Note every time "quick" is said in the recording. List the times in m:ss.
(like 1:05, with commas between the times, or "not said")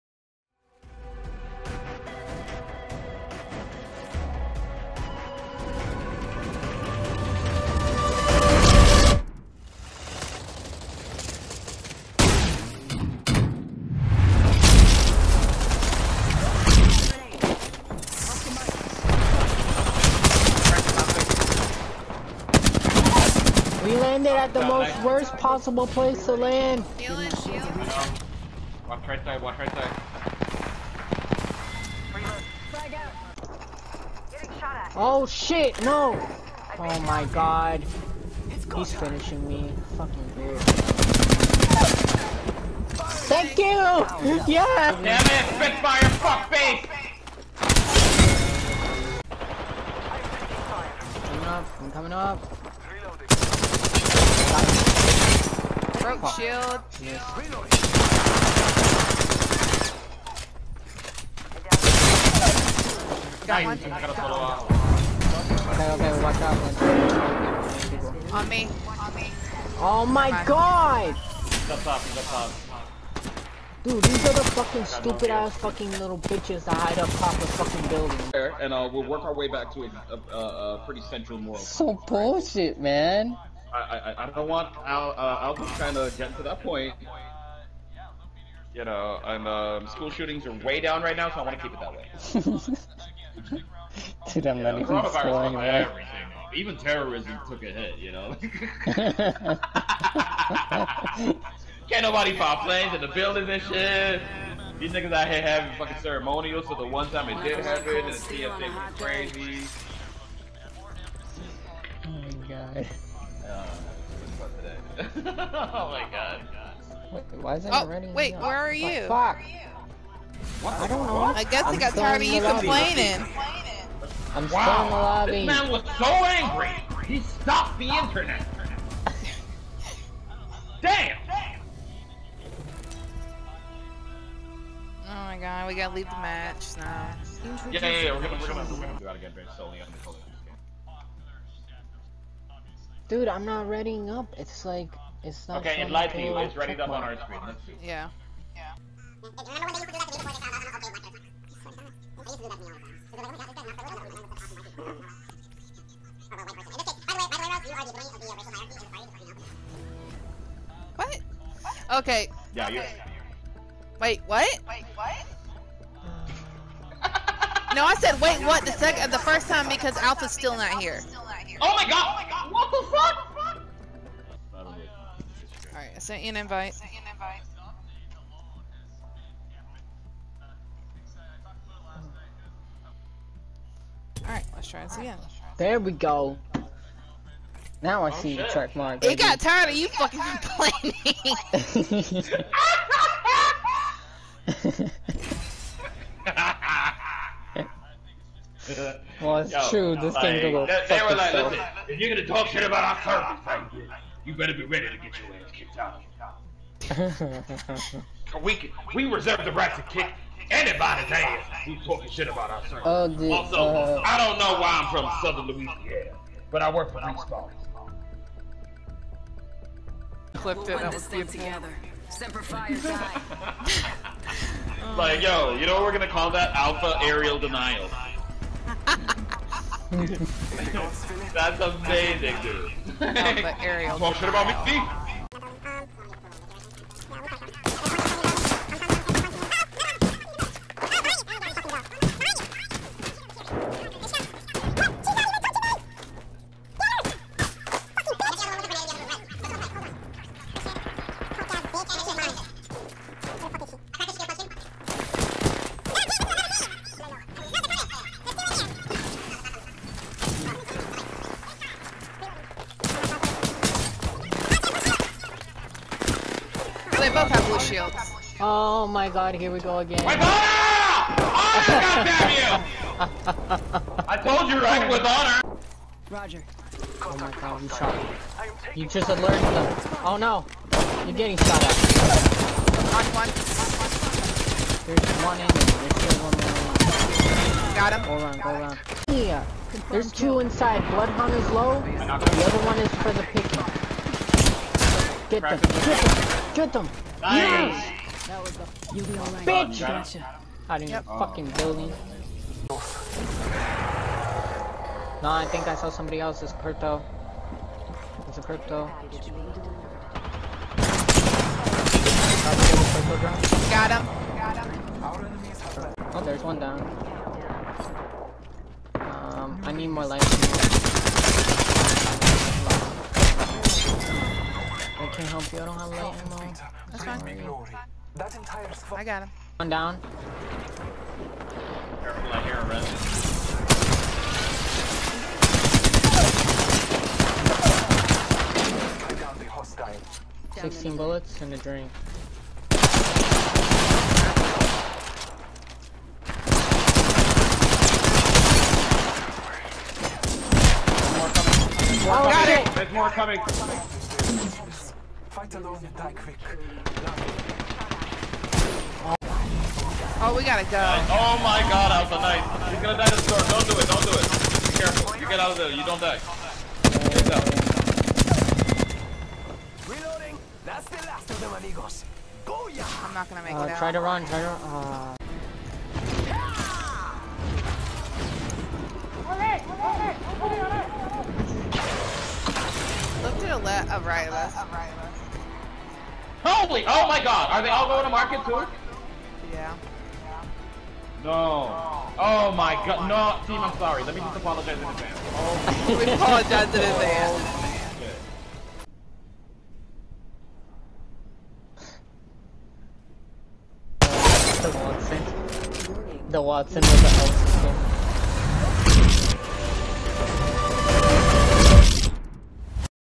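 5:56.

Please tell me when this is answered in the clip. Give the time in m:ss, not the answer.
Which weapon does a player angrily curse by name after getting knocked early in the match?
0:45.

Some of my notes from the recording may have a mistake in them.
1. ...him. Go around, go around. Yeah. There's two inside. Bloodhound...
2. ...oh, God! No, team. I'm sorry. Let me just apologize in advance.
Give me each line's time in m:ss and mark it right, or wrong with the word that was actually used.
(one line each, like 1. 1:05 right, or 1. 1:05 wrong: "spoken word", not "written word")
1. 4:47 right
2. 6:32 right.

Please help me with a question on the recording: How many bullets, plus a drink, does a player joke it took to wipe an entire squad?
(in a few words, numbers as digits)
16.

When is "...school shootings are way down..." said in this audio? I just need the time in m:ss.
1:29.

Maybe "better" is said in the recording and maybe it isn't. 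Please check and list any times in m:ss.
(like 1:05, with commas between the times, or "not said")
3:24.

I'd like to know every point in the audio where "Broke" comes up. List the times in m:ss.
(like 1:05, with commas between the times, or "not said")
0:56.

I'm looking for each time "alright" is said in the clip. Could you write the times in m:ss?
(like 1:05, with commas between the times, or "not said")
2:55, 3:04, 4:59.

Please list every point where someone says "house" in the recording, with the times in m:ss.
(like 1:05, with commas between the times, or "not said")
6:47.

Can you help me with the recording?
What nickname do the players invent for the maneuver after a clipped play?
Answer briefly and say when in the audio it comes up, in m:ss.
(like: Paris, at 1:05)
Alpha aerial denial, at 3:46.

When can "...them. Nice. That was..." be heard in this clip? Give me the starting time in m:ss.
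4:56.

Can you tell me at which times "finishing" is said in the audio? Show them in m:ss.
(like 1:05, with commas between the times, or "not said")
0:38.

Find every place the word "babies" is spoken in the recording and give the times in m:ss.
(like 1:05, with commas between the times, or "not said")
not said.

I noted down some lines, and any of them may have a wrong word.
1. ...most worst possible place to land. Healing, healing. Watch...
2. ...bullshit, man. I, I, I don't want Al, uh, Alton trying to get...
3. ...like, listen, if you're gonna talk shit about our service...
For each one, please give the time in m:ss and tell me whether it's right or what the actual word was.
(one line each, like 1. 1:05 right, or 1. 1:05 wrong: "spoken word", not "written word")
1. 0:24 right
2. 1:22 right
3. 3:21 right.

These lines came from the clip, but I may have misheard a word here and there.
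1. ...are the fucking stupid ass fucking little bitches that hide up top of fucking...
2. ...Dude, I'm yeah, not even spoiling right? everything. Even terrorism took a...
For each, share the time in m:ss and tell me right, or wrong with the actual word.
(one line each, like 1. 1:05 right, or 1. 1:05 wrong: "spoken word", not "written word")
1. 1:14 right
2. 1:34 right.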